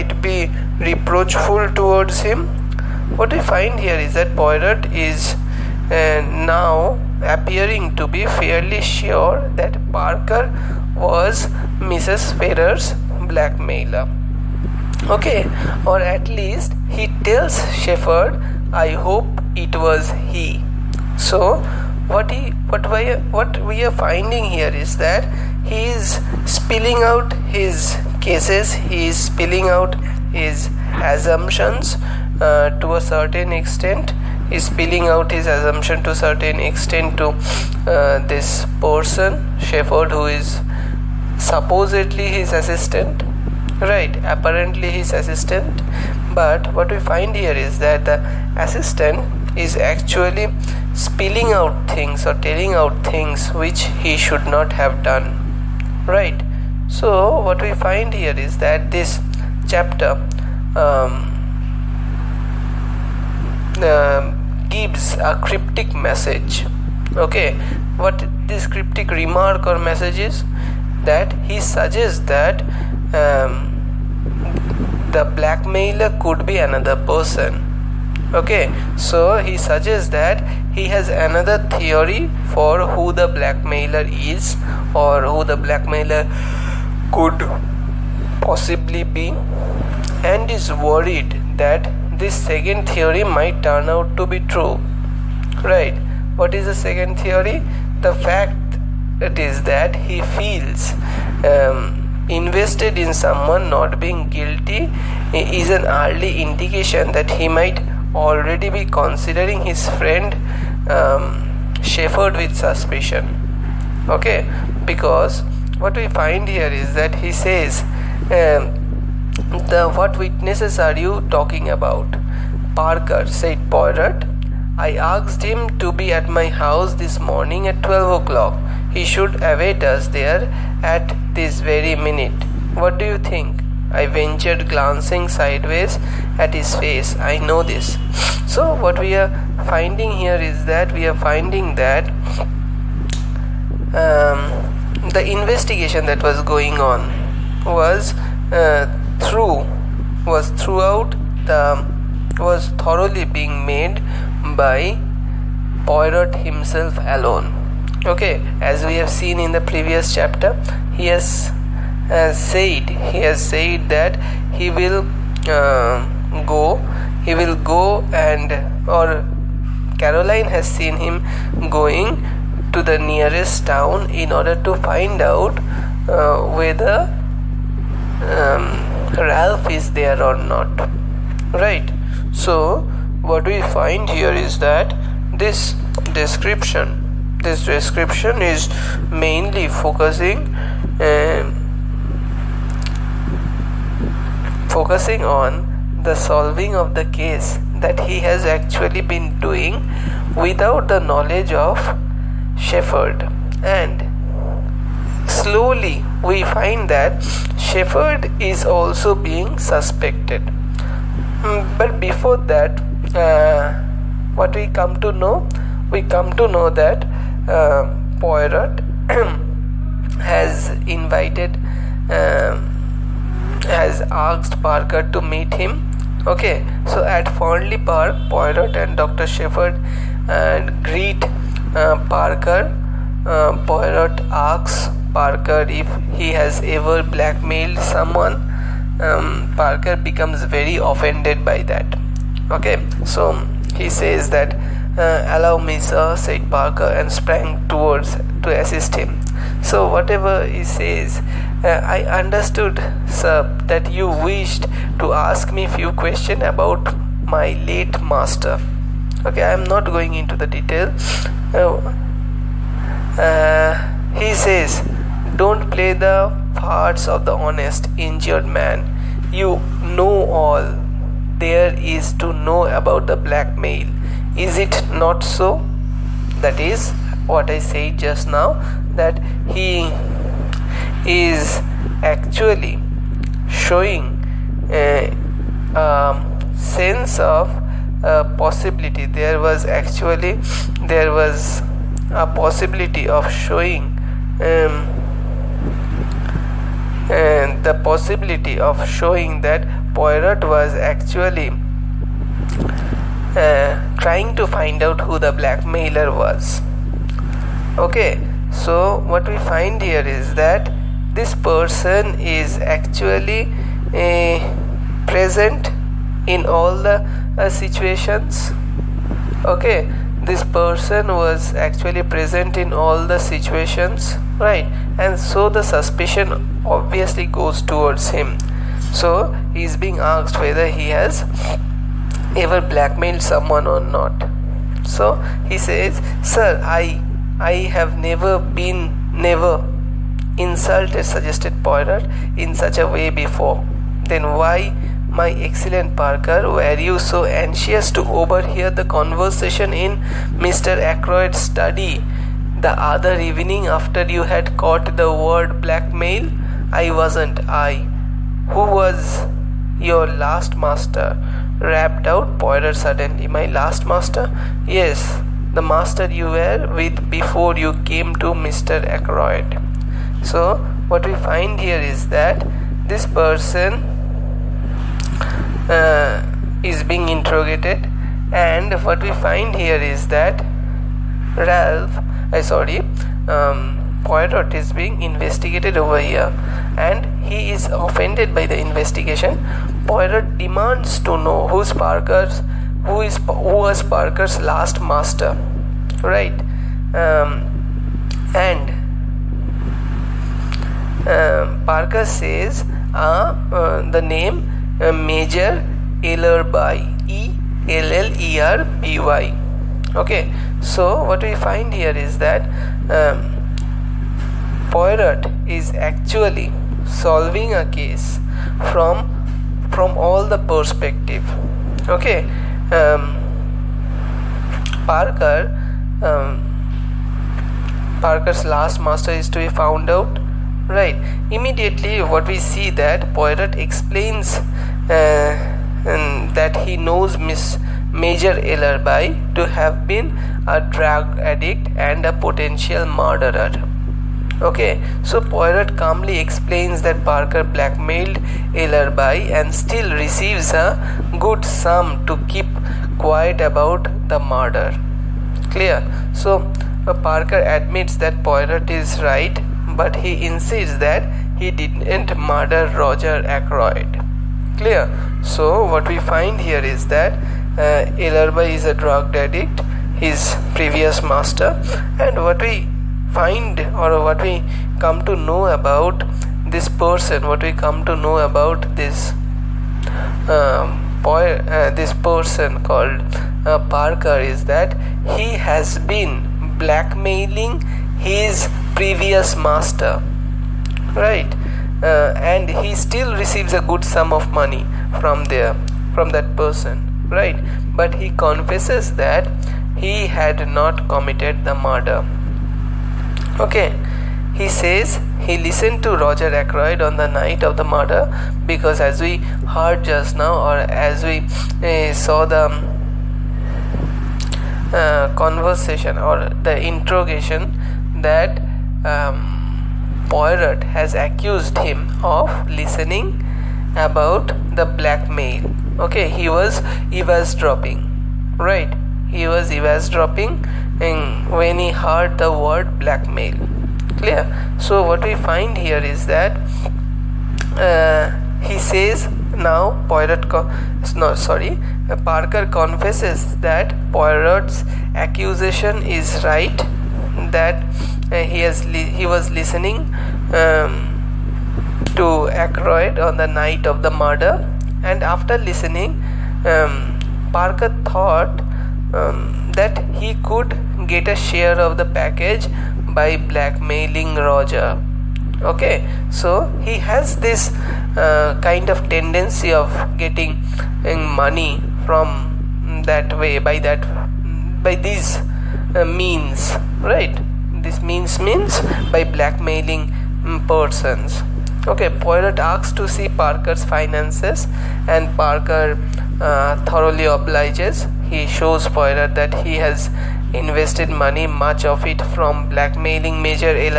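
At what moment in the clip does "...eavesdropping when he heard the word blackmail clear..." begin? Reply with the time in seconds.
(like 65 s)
529 s.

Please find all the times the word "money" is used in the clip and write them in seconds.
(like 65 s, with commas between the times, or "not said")
494 s, 571 s, 590 s.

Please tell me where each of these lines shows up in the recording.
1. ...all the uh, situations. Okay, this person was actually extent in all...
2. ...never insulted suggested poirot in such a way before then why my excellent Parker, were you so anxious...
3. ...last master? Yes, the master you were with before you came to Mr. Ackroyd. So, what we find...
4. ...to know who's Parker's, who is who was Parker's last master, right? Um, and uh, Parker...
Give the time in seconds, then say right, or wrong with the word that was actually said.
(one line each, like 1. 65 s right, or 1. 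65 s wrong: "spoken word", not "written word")
1. 316 s wrong: "present", not "extent"
2. 339 s right
3. 363 s right
4. 391 s right.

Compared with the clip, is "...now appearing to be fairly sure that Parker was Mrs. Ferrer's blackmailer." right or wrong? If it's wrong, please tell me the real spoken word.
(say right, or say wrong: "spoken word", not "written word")
right.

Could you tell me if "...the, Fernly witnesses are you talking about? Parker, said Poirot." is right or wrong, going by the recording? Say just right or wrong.
wrong.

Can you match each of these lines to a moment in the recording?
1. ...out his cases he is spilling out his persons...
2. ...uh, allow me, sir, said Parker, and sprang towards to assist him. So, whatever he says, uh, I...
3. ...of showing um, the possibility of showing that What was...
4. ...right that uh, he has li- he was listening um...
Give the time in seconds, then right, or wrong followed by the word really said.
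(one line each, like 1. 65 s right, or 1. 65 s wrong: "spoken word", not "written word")
1. 27 s wrong: "assumptions", not "persons"
2. 244 s right
3. 293 s wrong: "Poirot", not "What"
4. 546 s right.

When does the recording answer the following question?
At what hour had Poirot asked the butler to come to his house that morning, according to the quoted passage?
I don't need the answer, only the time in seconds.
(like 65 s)
127 s.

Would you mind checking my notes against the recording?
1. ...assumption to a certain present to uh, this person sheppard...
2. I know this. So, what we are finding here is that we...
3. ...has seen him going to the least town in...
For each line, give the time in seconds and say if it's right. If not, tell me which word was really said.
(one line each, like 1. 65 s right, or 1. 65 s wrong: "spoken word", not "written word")
1. 35 s wrong: "extent", not "present"
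2. 137 s right
3. 170 s wrong: "nearest", not "least".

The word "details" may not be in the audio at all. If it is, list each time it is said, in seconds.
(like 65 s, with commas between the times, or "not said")
260 s.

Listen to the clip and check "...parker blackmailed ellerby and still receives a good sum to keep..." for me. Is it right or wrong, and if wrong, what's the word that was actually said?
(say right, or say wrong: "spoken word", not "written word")
right.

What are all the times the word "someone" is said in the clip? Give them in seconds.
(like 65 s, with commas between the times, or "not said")
103 s, 237 s, 333 s.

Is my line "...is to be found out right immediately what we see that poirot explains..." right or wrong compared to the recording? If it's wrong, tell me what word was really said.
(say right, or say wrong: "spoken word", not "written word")
right.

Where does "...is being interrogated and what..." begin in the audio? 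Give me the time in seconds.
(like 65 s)
376 s.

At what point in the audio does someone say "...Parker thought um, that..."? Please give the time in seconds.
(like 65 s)
557 s.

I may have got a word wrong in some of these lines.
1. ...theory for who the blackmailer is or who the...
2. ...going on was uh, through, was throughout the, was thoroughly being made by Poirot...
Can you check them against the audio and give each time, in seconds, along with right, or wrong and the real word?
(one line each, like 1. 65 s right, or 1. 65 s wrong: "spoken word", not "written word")
1. 81 s right
2. 146 s right.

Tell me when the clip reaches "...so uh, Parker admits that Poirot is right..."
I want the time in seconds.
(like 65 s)
456 s.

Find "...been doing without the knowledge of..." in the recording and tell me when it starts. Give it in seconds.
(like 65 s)
199 s.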